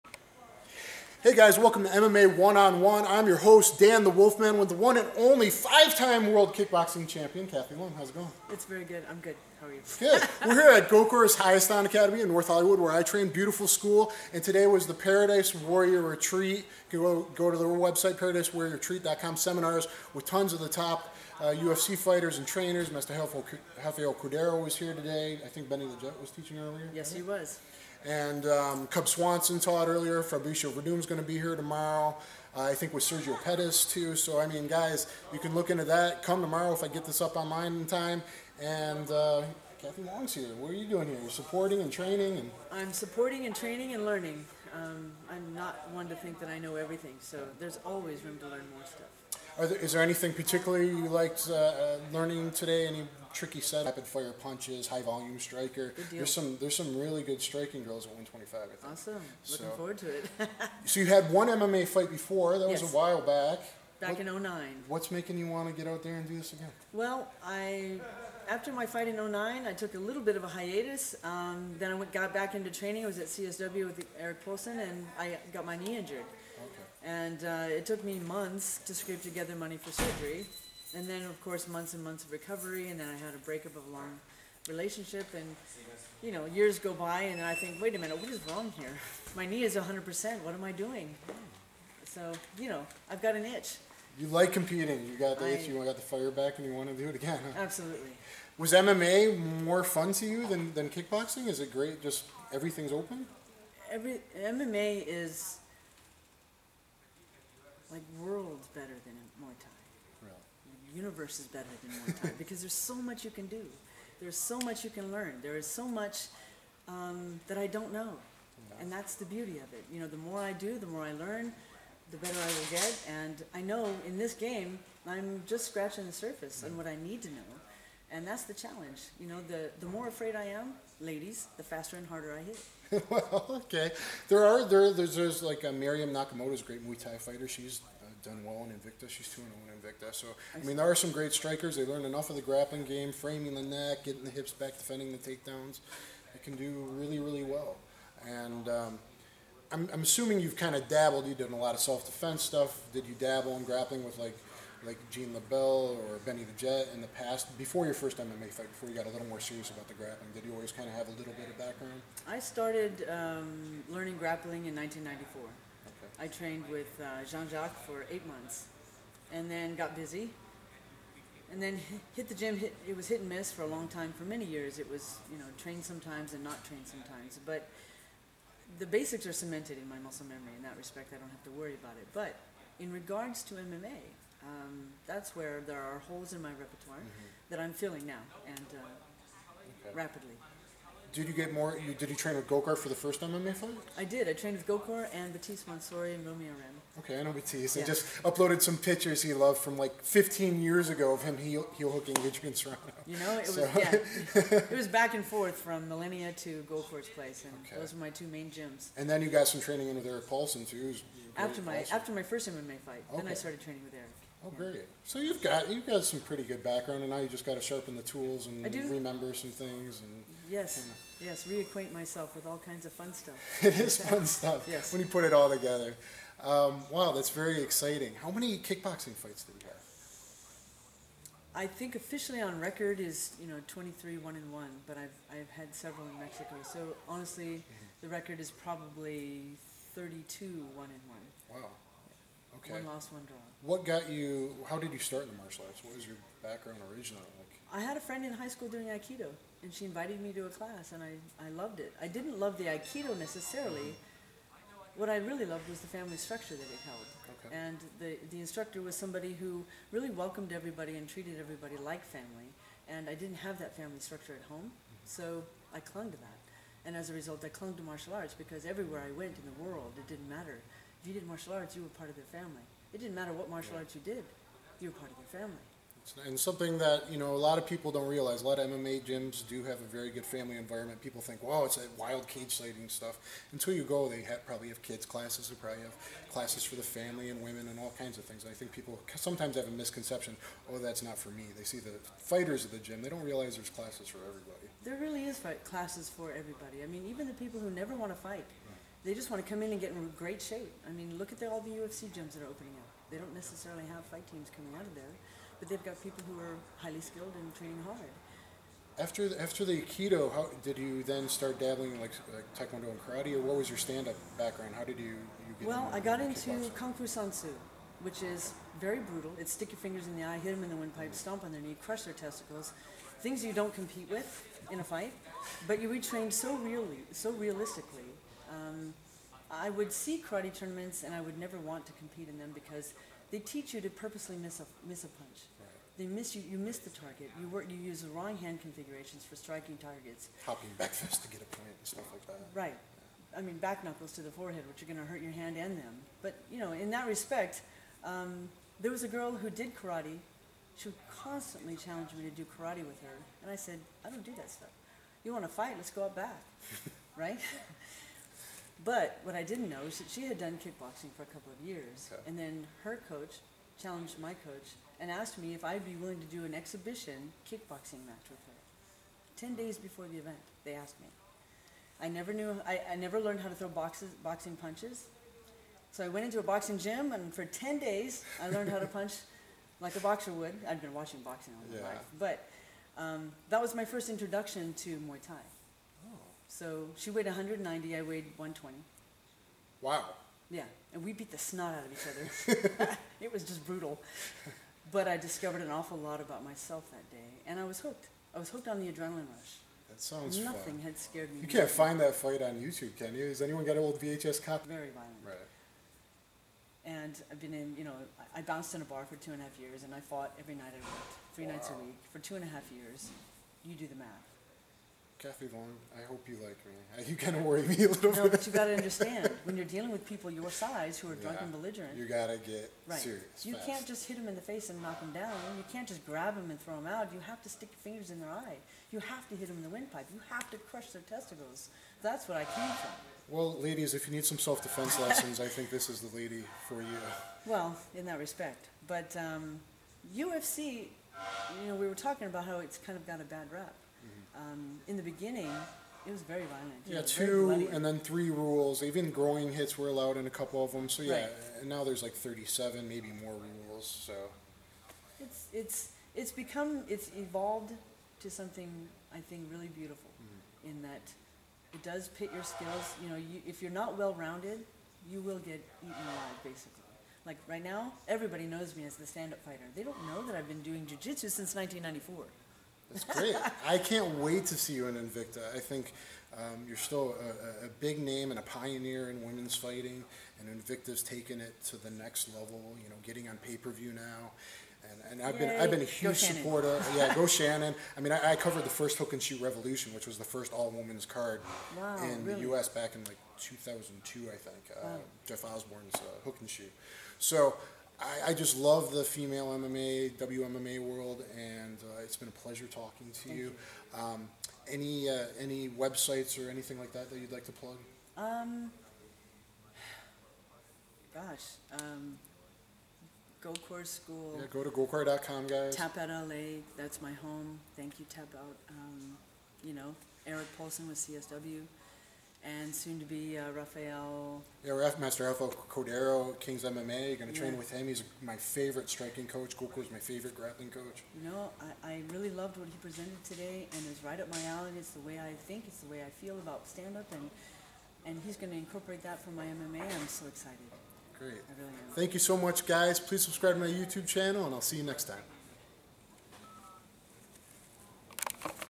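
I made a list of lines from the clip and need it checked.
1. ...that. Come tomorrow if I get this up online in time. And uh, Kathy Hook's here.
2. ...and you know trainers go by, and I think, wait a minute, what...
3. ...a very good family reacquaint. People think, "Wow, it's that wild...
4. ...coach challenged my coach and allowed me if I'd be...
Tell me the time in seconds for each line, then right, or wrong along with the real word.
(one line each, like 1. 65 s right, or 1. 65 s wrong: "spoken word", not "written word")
1. 35 s wrong: "Long", not "Hook"
2. 85 s wrong: "years", not "trainers"
3. 279 s wrong: "environment", not "reacquaint"
4. 363 s wrong: "asked", not "allowed".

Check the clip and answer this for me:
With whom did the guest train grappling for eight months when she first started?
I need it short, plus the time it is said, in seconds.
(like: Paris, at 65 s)
Jean Jacques, at 167 s.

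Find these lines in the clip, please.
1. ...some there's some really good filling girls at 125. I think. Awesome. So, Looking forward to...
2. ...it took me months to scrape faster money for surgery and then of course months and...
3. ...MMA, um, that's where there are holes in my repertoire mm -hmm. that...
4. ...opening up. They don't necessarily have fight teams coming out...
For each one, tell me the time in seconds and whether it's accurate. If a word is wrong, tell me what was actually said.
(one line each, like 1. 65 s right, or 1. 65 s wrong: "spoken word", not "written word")
1. 56 s wrong: "striking", not "filling"
2. 77 s wrong: "together", not "faster"
3. 183 s right
4. 302 s right.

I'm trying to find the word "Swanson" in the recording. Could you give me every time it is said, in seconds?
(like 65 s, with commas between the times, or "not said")
29 s.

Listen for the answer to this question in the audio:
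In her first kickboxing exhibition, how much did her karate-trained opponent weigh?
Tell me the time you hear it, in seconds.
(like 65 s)
387 s.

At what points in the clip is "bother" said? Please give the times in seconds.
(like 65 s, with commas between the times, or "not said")
not said.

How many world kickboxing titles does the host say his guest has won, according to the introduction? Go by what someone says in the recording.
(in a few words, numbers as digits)
5.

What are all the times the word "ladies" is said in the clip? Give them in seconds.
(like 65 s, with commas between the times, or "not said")
131 s, 433 s.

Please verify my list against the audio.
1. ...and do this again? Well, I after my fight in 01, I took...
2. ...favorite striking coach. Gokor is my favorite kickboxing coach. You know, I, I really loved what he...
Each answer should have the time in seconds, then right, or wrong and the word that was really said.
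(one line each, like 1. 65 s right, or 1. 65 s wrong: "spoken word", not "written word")
1. 66 s wrong: "09", not "01"
2. 528 s wrong: "grappling", not "kickboxing".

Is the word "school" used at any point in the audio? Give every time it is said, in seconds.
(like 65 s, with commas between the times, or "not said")
13 s, 248 s, 513 s.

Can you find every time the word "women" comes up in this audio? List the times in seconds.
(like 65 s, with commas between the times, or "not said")
287 s, 479 s, 490 s.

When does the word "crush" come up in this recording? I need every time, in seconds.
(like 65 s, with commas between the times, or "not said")
321 s, 430 s.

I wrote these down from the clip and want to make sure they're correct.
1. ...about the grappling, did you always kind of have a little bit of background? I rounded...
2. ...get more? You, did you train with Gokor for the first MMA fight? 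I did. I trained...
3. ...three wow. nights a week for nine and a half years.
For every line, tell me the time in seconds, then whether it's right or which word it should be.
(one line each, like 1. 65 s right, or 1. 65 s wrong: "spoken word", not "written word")
1. 159 s wrong: "started", not "rounded"
2. 191 s right
3. 411 s wrong: "two", not "nine".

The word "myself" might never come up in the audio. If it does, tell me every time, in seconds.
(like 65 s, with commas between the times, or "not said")
221 s, 396 s.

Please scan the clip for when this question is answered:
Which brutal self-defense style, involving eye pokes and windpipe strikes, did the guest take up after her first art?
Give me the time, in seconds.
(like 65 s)
316 s.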